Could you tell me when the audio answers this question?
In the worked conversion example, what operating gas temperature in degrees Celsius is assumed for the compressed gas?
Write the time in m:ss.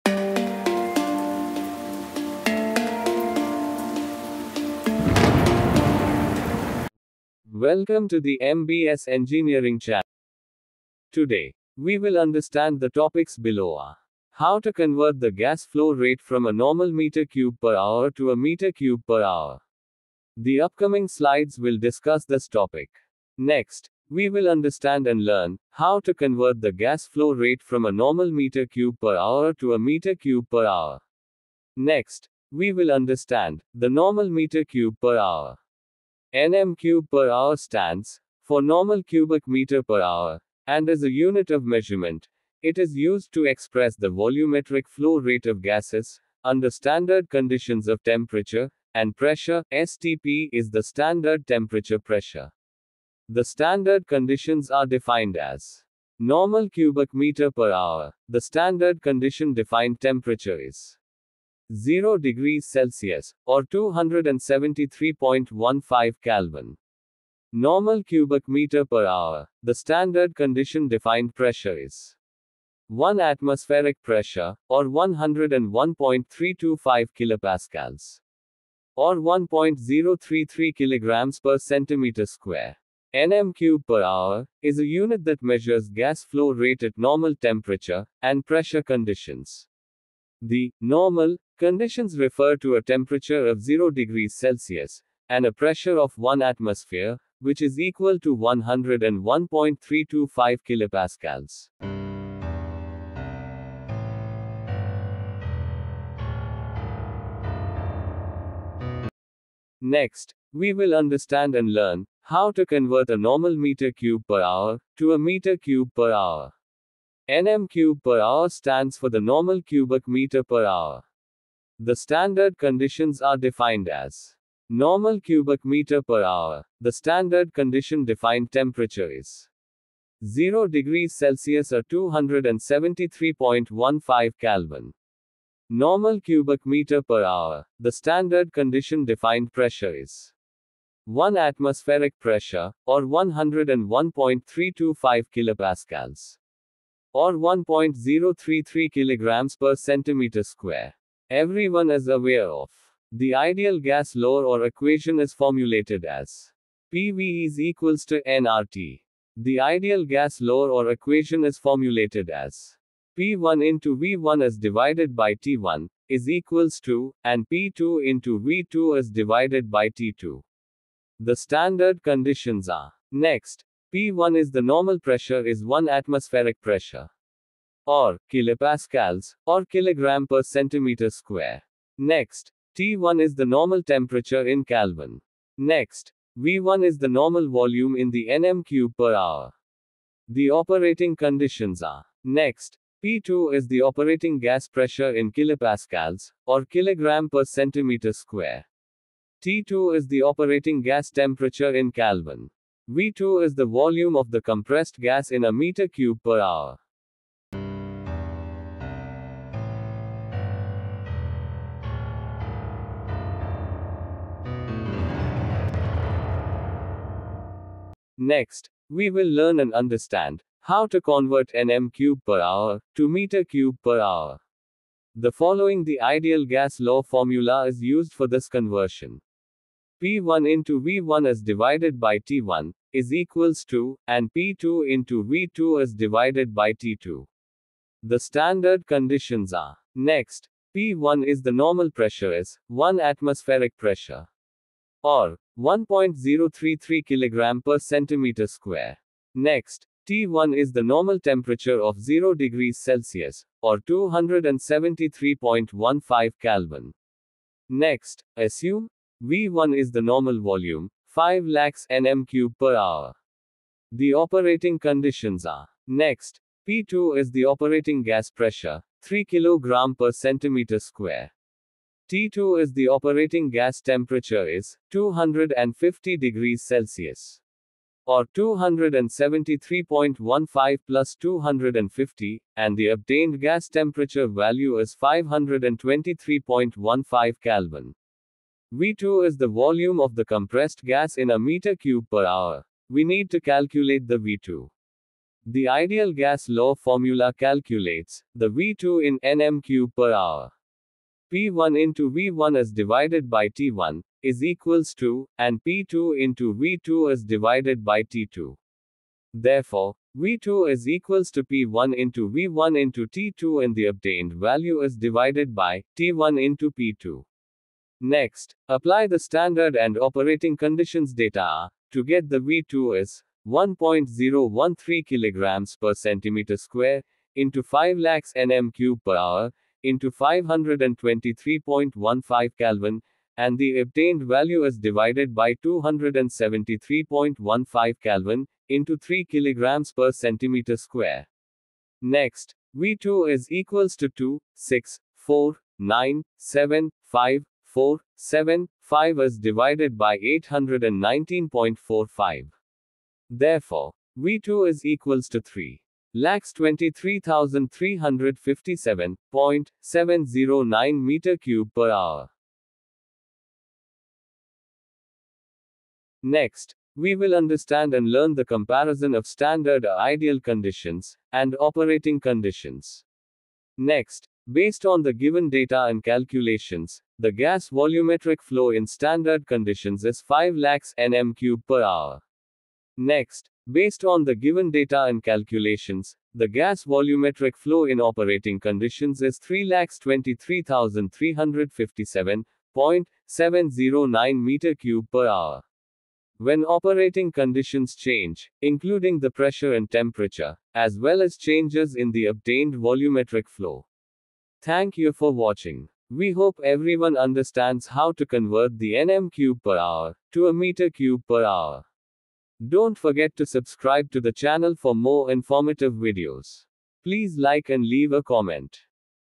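4:34.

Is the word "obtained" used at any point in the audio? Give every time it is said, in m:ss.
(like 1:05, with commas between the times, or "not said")
4:42, 5:13, 5:33, 6:42.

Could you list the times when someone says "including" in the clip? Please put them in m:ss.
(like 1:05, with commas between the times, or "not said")
6:38.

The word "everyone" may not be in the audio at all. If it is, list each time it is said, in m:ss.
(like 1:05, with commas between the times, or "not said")
2:31, 6:46.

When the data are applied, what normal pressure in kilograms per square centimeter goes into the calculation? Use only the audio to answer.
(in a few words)
1.013.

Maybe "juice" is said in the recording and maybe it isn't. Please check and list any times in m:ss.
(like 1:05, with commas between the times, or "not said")
not said.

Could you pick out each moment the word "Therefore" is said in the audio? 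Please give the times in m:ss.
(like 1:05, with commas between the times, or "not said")
5:09, 5:53.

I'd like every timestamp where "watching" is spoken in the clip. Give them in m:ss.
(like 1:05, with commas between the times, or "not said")
6:45.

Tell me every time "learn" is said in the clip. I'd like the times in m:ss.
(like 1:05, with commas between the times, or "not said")
0:25, 1:51, 3:39, 6:08.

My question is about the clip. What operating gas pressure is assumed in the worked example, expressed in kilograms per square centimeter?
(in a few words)
3 kg per cm².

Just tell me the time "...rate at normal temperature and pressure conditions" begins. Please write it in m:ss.
1:26.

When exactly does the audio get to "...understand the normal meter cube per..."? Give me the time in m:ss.
0:32.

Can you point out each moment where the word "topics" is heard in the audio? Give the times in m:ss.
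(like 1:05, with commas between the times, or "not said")
0:12, 0:22.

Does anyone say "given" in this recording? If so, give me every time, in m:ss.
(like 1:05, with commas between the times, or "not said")
6:15, 6:24.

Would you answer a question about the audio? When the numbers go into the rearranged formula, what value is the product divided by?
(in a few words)
819.45.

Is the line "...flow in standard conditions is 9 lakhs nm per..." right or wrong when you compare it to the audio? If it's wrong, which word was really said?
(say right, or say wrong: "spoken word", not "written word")
wrong: "5", not "9".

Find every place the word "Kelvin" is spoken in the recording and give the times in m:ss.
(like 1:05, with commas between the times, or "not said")
1:06, 2:14, 3:04, 3:21, 4:16, 4:47, 5:32, 5:38.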